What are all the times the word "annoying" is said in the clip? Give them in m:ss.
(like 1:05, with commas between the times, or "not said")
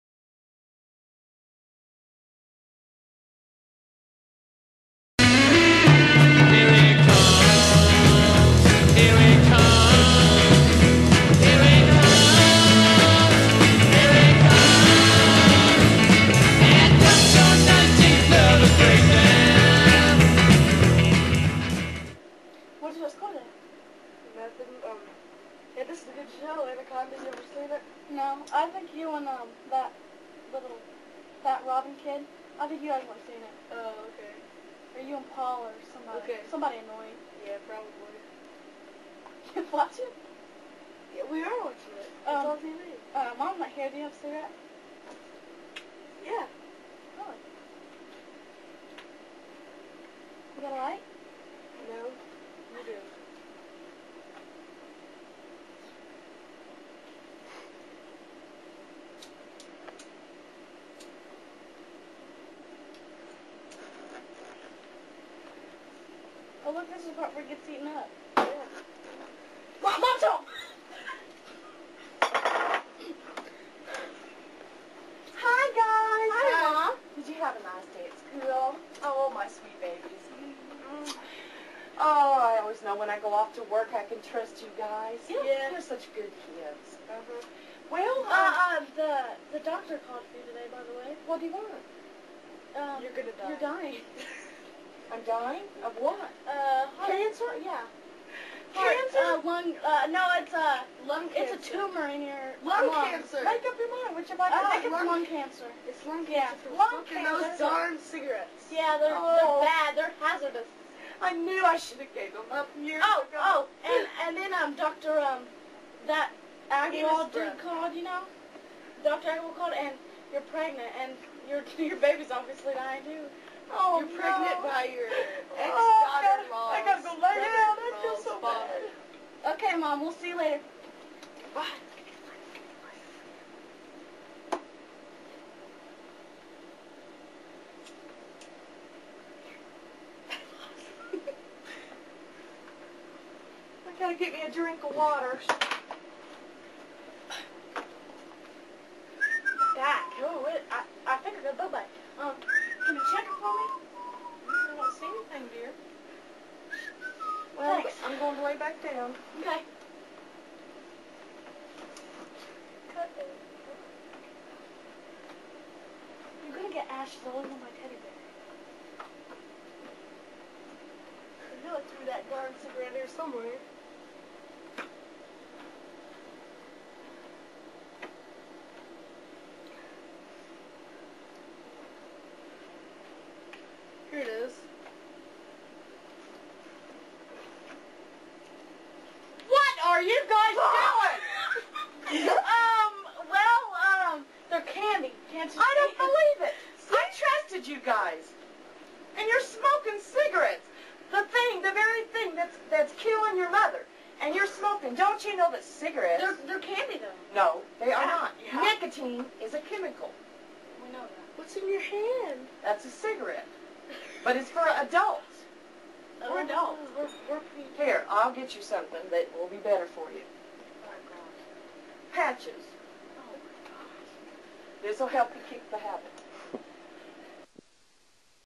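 0:36.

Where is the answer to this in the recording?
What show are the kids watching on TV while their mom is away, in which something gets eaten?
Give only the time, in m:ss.
0:26.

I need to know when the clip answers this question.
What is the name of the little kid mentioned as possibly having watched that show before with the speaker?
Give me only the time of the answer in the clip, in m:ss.
0:31.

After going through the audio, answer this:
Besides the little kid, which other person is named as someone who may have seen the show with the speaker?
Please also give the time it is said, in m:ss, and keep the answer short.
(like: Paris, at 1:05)
Paul, at 0:35.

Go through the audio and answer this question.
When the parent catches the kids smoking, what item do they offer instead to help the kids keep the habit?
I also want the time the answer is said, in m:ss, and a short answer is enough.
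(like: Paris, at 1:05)
Patches, at 3:42.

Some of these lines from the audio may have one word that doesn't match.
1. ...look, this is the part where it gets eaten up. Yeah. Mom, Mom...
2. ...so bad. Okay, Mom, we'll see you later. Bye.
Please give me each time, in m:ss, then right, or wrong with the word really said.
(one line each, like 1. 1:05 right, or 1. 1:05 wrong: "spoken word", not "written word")
1. 1:06 right
2. 2:08 right.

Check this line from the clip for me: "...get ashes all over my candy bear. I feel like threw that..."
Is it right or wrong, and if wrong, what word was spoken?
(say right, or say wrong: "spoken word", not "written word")
wrong: "teddy", not "candy".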